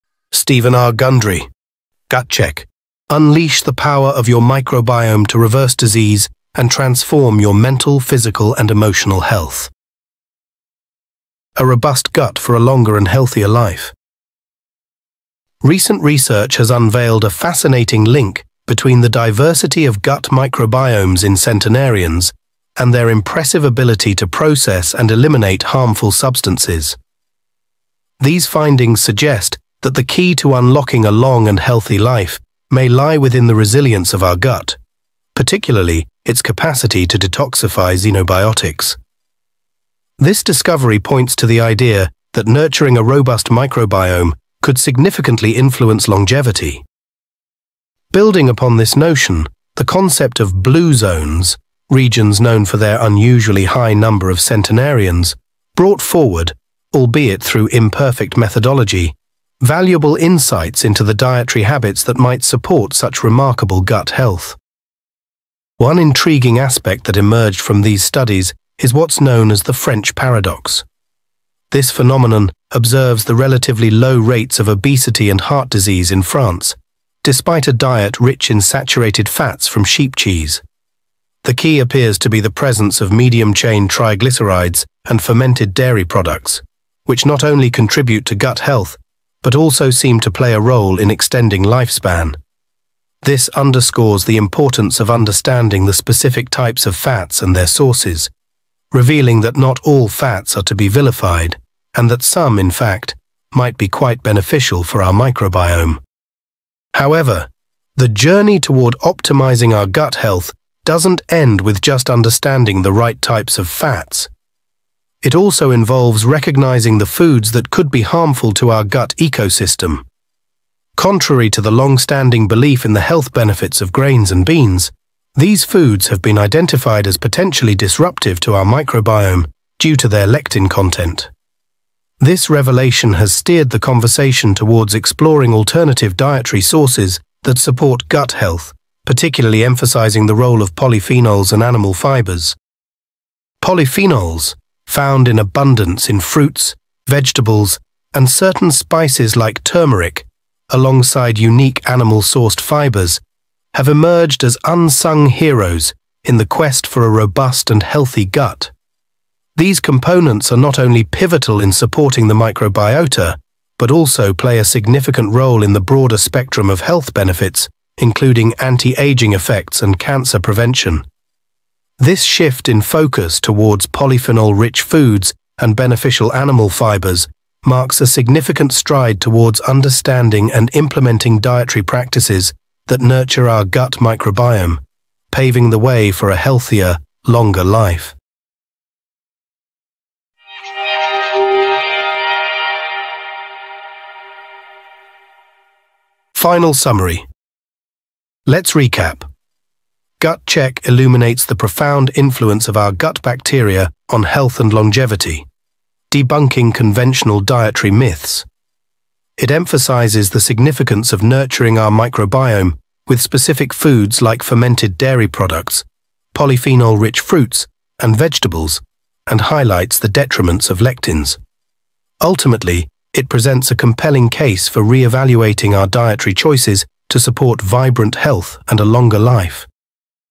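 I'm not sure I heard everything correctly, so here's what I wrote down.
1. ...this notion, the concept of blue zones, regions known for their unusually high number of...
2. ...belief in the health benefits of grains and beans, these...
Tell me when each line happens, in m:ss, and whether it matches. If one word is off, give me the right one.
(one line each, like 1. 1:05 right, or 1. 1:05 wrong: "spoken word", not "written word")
1. 0:48 right
2. 2:02 right.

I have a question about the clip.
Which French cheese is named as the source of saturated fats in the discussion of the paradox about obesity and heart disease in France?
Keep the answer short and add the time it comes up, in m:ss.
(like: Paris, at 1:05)
sheep cheese, at 1:19.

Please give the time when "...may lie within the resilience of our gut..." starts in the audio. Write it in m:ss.
0:32.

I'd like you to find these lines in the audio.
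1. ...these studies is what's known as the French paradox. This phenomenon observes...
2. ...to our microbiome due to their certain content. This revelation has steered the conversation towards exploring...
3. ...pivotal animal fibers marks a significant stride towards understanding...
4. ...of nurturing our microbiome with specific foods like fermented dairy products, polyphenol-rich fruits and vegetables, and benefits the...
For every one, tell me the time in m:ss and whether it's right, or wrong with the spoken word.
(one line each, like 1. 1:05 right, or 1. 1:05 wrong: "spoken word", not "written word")
1. 1:07 right
2. 2:08 wrong: "lectin", not "certain"
3. 2:55 wrong: "beneficial", not "pivotal"
4. 3:31 wrong: "highlights", not "benefits".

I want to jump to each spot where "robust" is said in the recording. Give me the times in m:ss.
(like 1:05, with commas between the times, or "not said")
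0:11, 0:43, 2:37.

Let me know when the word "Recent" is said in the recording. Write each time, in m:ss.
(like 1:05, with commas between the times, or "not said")
0:15.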